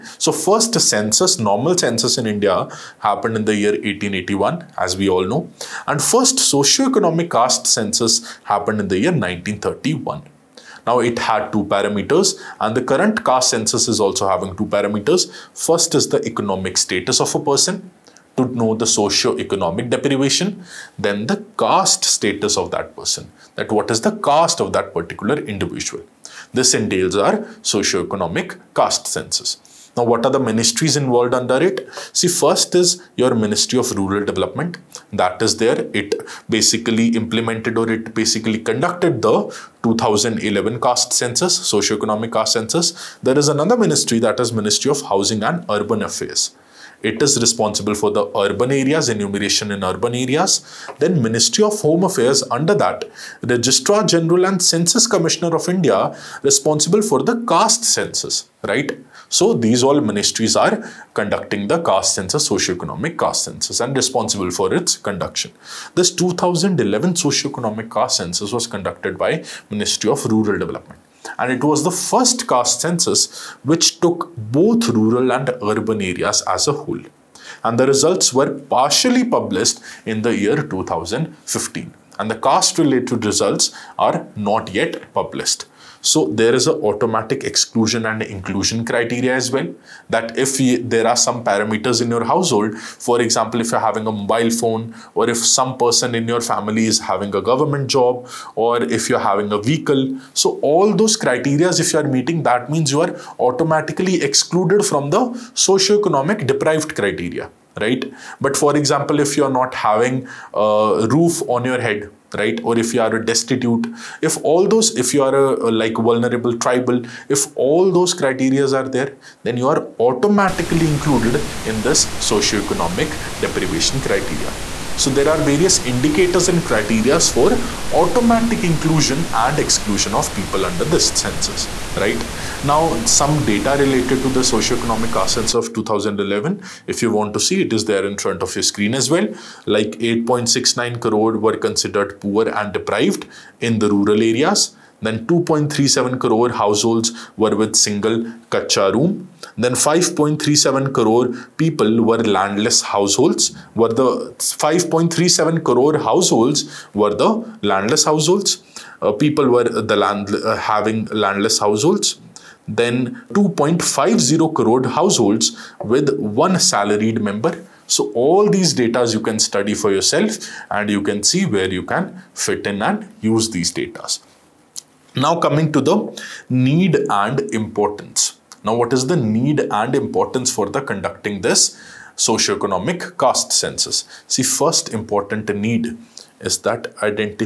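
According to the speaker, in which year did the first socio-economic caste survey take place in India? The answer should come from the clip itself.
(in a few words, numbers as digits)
1931.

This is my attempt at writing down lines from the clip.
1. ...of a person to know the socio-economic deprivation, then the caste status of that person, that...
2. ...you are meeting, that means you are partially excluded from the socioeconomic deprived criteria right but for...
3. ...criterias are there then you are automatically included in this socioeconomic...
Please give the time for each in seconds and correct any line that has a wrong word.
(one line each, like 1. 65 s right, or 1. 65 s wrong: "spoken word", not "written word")
1. 17 s right
2. 101 s wrong: "automatically", not "partially"
3. 118 s right.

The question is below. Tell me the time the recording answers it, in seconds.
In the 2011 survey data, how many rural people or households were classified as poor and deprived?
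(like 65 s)
139 s.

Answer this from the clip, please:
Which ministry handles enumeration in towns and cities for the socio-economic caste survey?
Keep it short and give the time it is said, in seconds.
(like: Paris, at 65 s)
Ministry of Housing and Urban Affairs, at 44 s.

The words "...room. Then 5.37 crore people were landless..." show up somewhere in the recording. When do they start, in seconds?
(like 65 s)
148 s.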